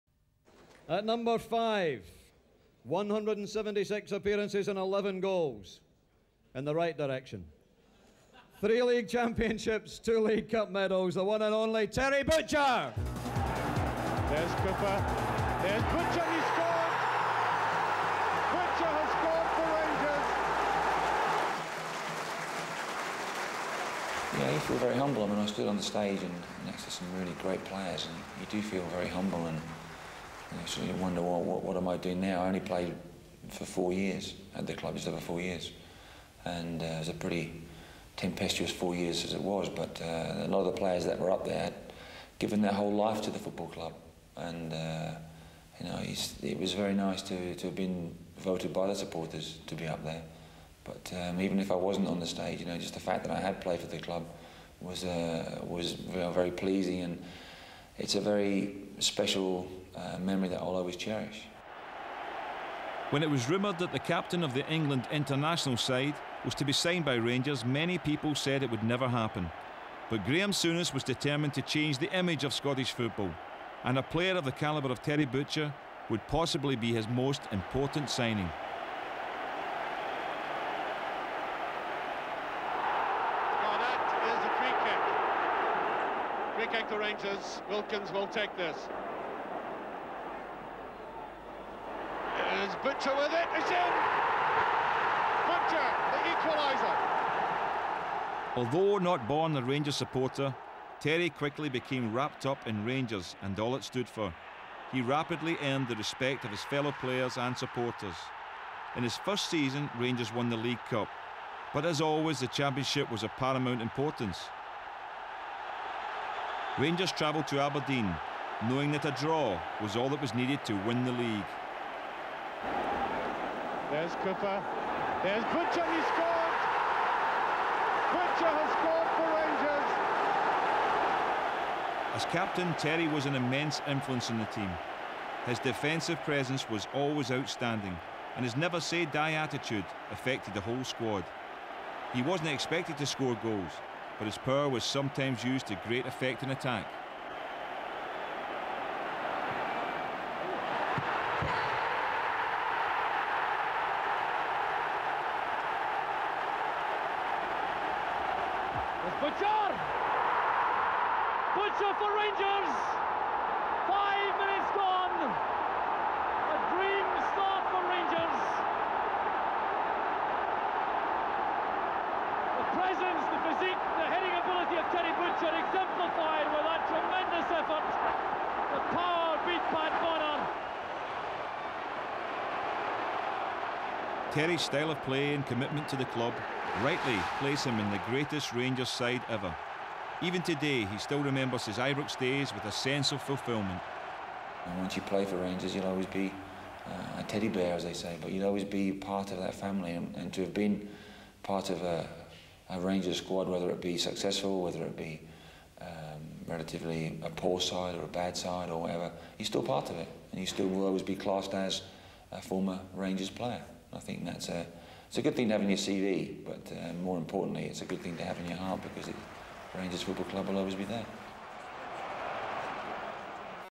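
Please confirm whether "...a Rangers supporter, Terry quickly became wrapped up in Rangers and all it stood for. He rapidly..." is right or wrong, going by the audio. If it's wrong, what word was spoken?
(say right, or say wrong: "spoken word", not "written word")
right.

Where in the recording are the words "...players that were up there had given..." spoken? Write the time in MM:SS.
00:40.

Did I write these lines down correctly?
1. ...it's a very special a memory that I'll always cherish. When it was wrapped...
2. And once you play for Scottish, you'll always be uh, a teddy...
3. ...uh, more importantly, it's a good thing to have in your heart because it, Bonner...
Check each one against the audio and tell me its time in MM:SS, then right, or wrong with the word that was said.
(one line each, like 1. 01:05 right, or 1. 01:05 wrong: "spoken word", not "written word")
1. 00:57 wrong: "rumoured", not "wrapped"
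2. 03:14 wrong: "Rangers", not "Scottish"
3. 03:36 wrong: "Rangers", not "Bonner".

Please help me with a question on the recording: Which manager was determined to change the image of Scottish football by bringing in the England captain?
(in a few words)
Graham Souness.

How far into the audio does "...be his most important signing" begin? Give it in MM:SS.
01:16.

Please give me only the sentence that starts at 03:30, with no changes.
And you still will always be classed as a former Rangers player.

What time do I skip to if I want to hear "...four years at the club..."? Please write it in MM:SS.
00:33.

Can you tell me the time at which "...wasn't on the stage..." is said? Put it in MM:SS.
00:51.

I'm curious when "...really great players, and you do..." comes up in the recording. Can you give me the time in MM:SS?
00:27.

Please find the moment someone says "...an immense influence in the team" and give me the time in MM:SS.
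02:13.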